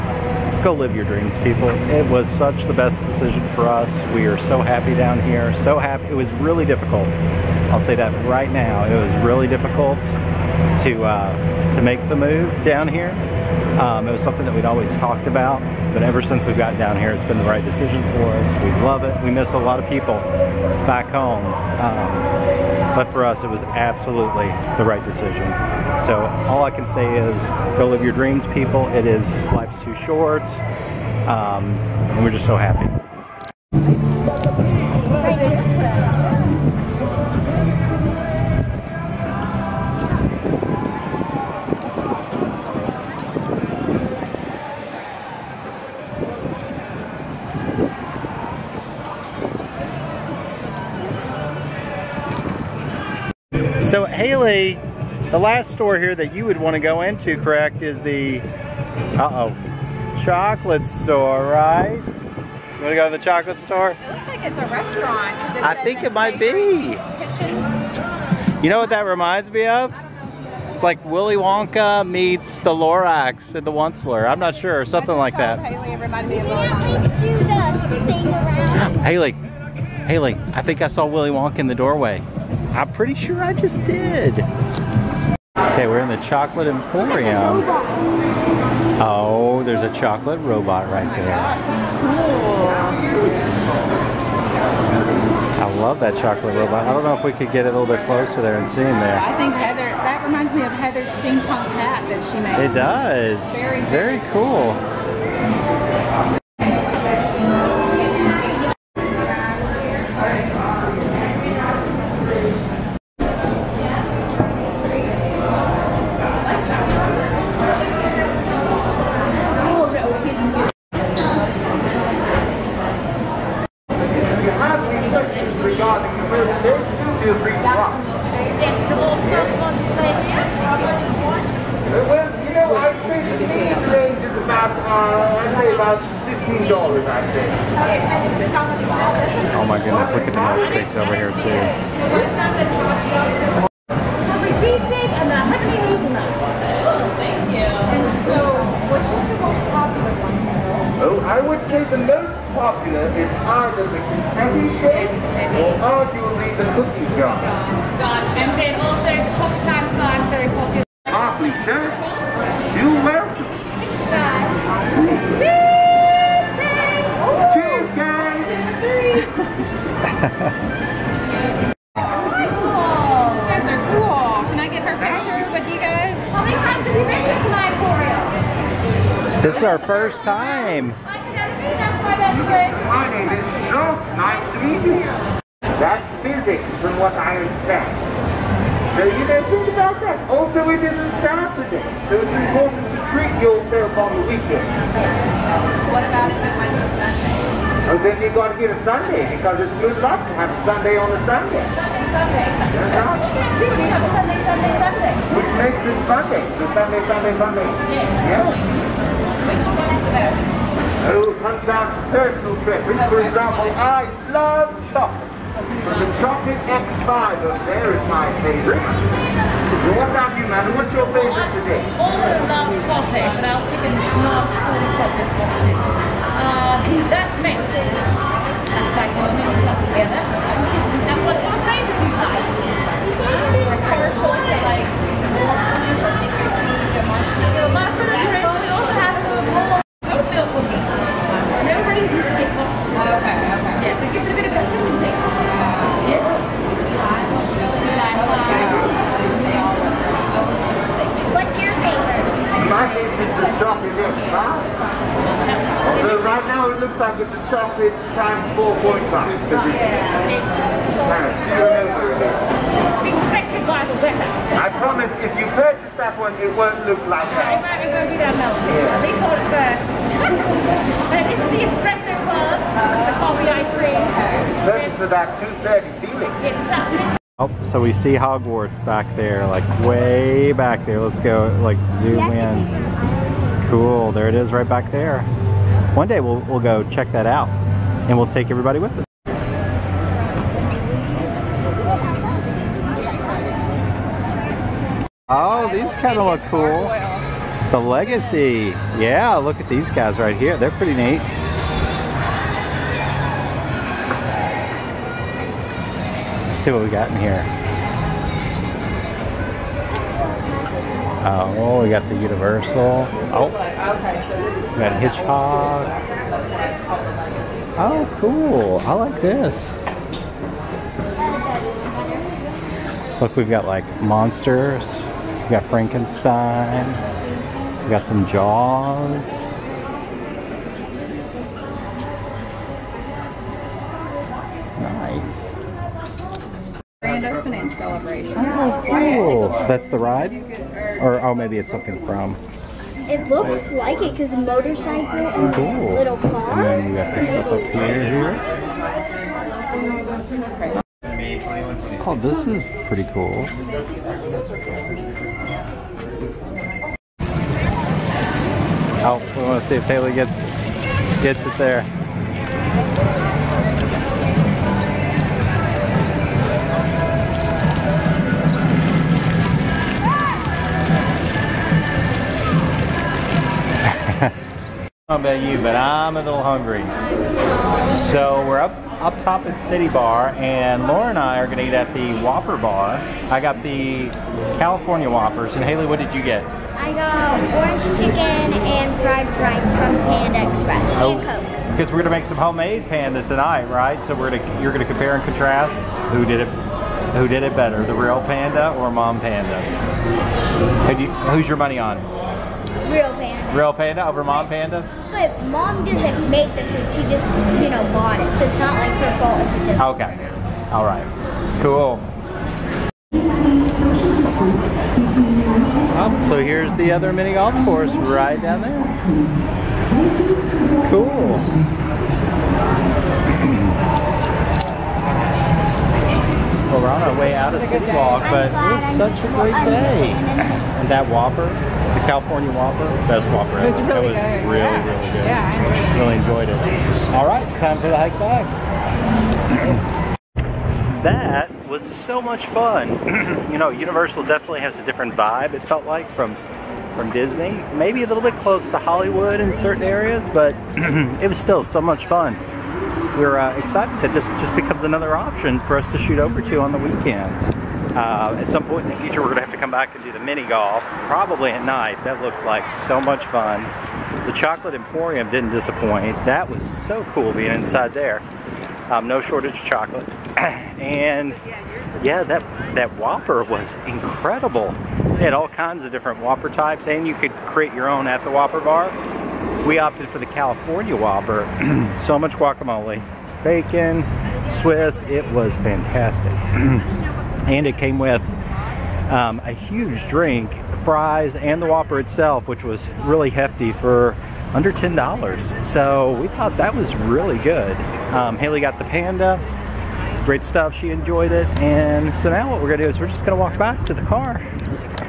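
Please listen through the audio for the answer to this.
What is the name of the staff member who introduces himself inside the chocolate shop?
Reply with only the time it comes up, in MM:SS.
03:03.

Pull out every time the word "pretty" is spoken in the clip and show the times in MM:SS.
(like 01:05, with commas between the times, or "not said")
01:22, 05:00, 05:52.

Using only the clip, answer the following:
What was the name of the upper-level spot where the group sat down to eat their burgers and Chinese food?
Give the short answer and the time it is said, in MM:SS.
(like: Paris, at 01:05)
City Bar, at 06:19.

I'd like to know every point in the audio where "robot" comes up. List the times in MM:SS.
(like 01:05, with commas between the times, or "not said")
01:30, 01:36.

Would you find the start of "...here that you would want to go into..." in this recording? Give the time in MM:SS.
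00:55.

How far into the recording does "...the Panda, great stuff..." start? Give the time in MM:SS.
08:18.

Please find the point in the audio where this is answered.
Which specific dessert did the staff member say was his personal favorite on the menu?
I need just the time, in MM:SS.
03:36.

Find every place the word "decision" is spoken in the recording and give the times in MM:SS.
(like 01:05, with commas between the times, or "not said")
00:03, 00:17, 00:25.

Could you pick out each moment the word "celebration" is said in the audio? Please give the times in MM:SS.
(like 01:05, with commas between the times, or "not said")
05:37.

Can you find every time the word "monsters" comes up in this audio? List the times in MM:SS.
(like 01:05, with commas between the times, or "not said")
05:23.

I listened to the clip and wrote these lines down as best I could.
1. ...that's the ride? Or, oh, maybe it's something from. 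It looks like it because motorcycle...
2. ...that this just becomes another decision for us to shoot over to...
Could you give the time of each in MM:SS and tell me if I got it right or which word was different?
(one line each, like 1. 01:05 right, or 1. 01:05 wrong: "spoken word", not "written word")
1. 05:39 right
2. 07:34 wrong: "option", not "decision".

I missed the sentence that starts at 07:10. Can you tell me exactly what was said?
And that Whopper, the California Whopper, best Whopper ever.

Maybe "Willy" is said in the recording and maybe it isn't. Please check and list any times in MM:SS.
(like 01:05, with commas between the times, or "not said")
01:11, 01:21.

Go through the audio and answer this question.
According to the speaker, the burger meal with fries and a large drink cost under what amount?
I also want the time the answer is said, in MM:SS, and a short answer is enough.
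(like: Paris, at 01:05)
$10, at 08:14.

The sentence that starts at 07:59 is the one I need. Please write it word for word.
We opted for the California Whopper.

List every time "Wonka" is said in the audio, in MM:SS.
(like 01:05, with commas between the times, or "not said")
01:11, 01:21.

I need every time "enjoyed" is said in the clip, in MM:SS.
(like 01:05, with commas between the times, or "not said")
07:16, 08:20.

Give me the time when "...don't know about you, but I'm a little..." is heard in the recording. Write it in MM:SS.
06:15.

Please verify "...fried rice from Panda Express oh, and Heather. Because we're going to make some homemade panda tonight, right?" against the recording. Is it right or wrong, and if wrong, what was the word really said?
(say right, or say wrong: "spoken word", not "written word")
wrong: "Coke", not "Heather".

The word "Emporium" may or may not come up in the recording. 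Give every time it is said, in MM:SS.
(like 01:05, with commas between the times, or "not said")
01:26, 07:44.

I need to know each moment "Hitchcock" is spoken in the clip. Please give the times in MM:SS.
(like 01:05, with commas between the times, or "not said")
05:15.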